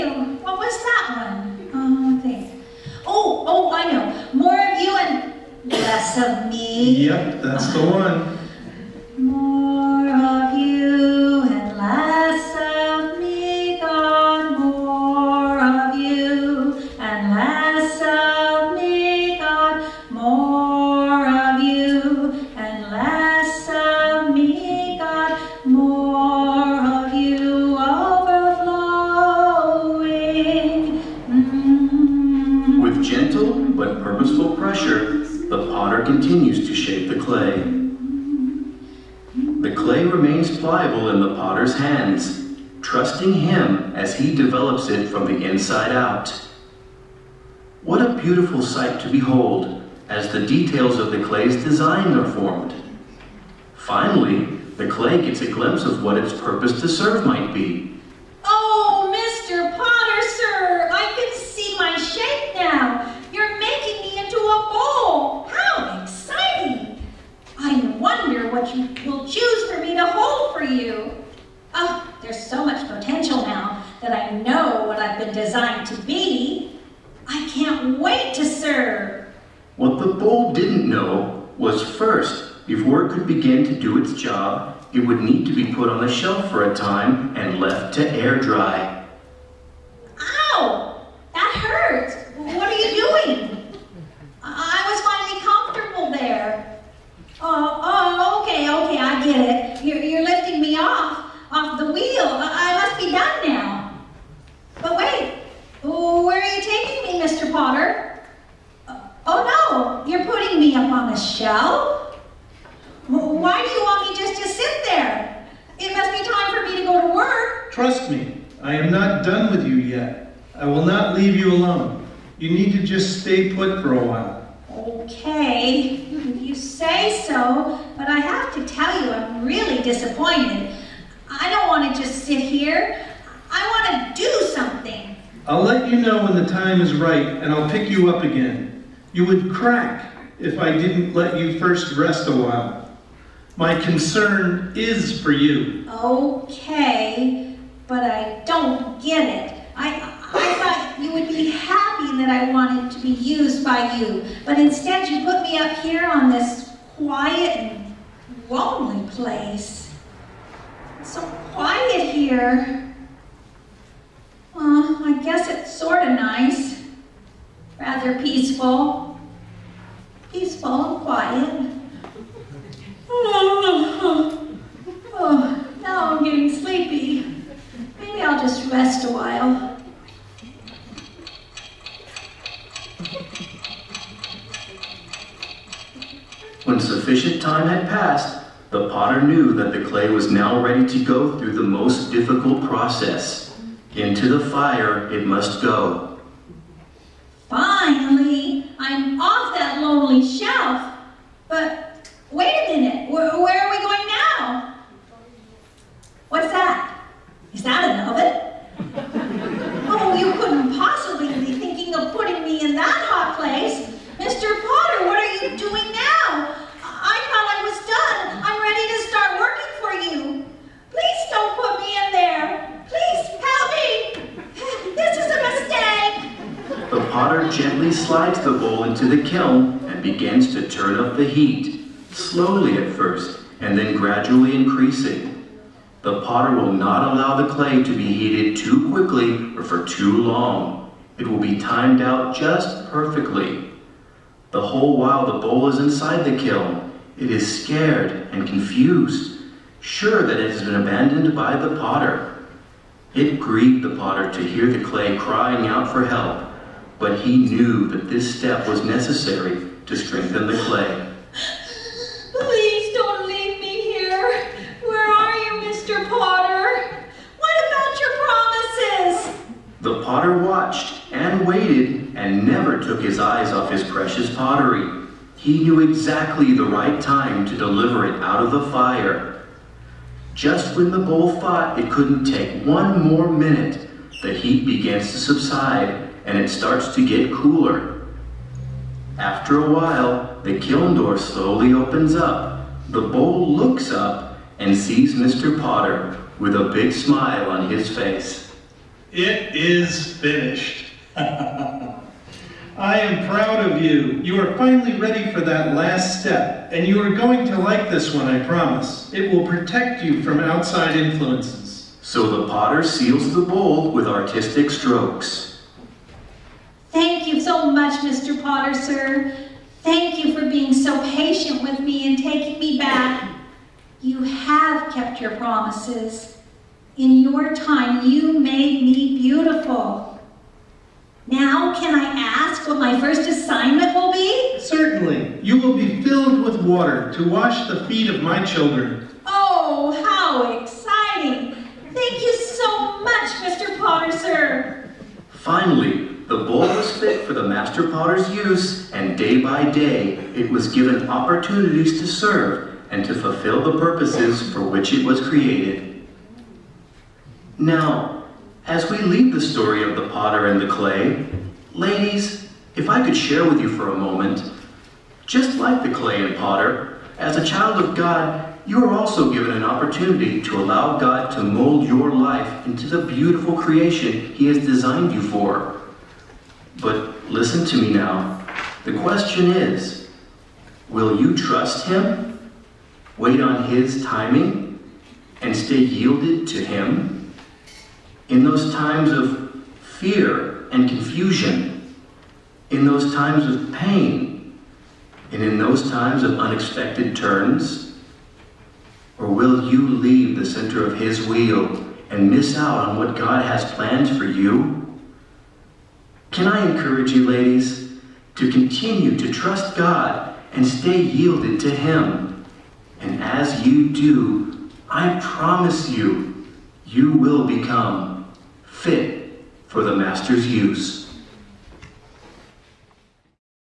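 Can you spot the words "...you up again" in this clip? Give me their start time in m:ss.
2:17.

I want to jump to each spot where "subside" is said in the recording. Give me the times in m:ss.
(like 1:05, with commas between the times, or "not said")
4:45.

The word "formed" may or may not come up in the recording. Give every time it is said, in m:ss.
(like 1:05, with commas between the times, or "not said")
0:52.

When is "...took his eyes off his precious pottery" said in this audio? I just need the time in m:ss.
4:32.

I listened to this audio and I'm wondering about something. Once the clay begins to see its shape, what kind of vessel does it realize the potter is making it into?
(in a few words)
A bowl.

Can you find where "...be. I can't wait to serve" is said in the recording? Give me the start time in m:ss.
1:16.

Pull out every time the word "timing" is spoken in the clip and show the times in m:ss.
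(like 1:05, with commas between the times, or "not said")
6:24.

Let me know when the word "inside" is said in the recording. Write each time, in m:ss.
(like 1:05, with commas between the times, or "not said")
0:45, 4:05.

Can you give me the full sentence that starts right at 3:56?
The potter will not allow the clay to be heated too quickly or for too long.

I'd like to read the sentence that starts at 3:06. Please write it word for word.
When sufficient time had passed, the potter knew that the clay was now ready to go through the most difficult process.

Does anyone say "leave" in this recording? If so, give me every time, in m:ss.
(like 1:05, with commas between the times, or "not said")
2:01, 4:23, 5:58, 6:39.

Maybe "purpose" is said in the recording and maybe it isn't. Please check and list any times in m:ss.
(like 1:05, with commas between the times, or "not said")
0:56, 5:53.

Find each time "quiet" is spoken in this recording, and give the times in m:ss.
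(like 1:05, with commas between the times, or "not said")
2:36, 2:41, 2:51.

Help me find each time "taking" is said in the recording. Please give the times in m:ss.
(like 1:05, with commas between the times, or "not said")
5:22.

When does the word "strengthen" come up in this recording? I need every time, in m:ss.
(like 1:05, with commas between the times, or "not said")
4:19.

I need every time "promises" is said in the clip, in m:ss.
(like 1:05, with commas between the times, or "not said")
4:29, 5:08, 5:25, 6:55.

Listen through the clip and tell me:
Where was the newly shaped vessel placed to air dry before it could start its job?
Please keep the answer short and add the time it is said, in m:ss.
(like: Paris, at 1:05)
On the shelf, at 1:25.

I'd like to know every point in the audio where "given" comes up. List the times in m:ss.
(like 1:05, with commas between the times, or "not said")
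5:50, 6:09.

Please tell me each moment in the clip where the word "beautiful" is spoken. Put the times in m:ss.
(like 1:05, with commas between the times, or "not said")
0:48, 5:29, 6:13.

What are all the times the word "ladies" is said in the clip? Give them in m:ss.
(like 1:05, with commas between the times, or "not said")
6:01, 6:47.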